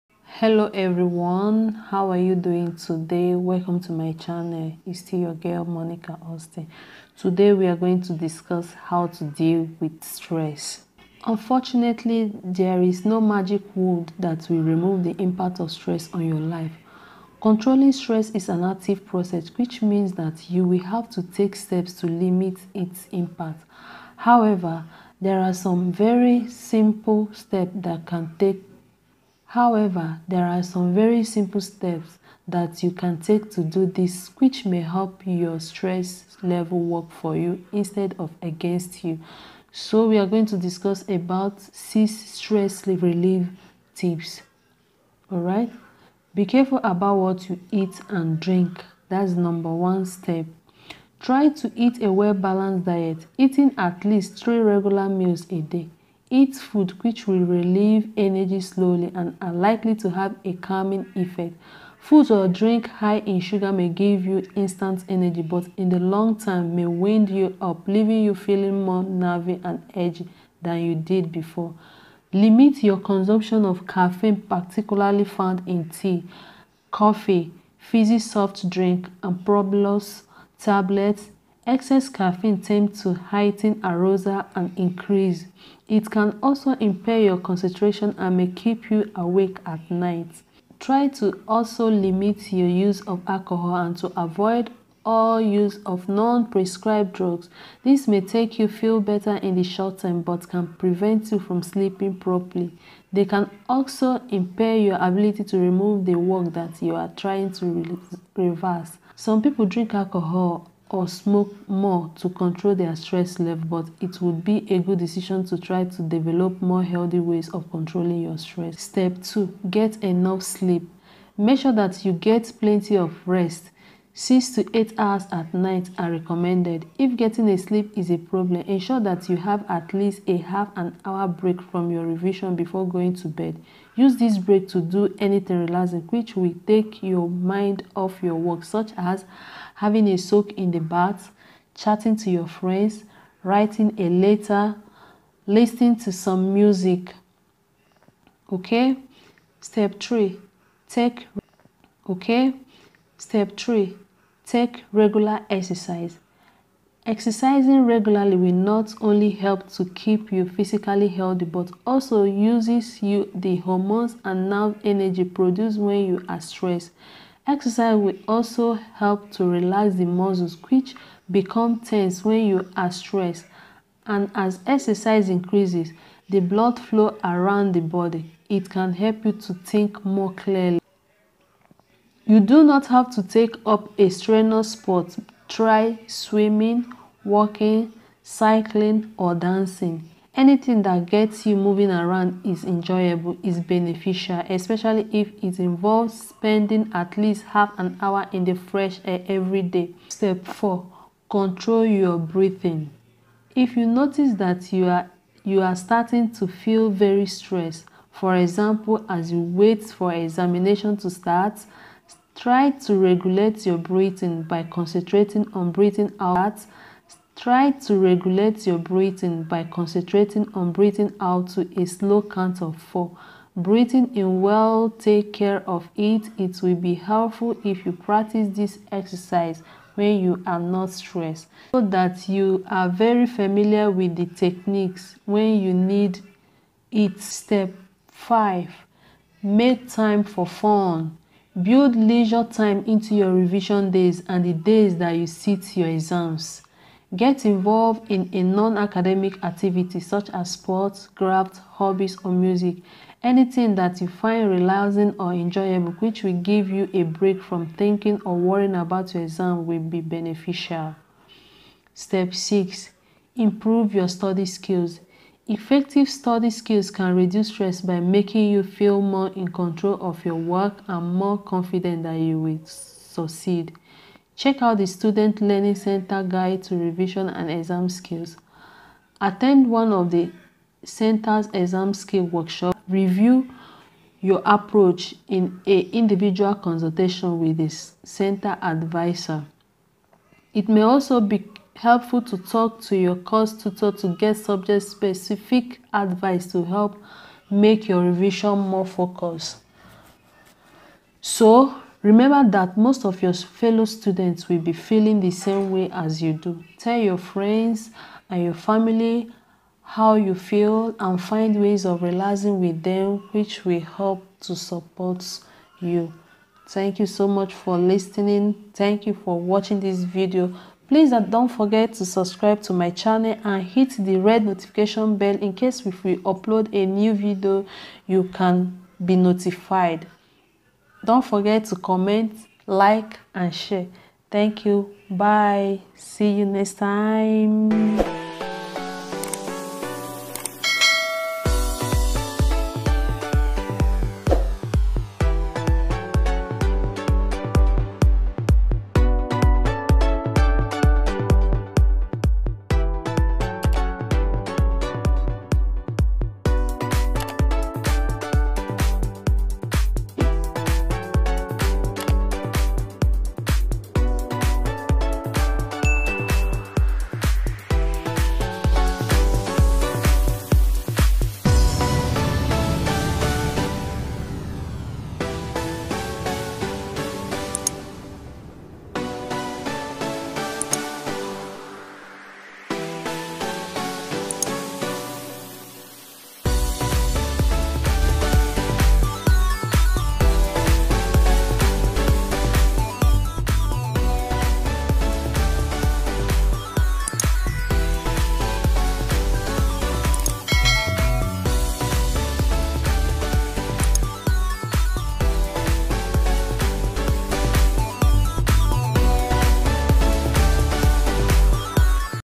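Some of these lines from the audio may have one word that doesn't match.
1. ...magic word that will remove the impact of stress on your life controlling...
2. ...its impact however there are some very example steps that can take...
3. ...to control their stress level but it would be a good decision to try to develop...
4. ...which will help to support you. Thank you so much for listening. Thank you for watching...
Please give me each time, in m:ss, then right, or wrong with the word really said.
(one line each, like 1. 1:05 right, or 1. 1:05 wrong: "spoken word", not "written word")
1. 0:13 right
2. 0:22 wrong: "simple", not "example"
3. 1:52 right
4. 5:13 right.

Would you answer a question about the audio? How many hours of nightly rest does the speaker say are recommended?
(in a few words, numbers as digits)
6 to 8.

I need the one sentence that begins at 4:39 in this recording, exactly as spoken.
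Attend one of the center's exam skill workshop.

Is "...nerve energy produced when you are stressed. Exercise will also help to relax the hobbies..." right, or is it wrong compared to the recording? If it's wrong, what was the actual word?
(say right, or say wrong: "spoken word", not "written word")
wrong: "muscles", not "hobbies".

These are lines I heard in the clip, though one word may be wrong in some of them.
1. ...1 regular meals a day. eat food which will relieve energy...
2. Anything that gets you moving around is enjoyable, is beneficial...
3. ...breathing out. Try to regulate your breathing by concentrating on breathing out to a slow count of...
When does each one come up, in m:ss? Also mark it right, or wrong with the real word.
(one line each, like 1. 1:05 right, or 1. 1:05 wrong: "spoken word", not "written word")
1. 0:54 wrong: "3", not "1"
2. 3:10 right
3. 3:35 right.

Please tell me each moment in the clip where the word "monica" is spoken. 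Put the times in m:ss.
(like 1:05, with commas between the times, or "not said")
0:05.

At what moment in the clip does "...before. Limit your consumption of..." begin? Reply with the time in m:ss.
1:11.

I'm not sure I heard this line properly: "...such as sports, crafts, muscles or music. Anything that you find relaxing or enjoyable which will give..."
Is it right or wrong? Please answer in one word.
wrong.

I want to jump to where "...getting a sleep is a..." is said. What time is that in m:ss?
2:07.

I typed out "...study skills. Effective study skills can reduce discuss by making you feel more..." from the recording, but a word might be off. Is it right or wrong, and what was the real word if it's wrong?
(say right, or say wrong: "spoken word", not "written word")
wrong: "stress", not "discuss".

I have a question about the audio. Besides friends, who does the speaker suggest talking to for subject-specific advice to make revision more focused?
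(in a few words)
course tutor.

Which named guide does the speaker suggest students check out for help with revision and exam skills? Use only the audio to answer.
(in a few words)
Student Learning Center Guide.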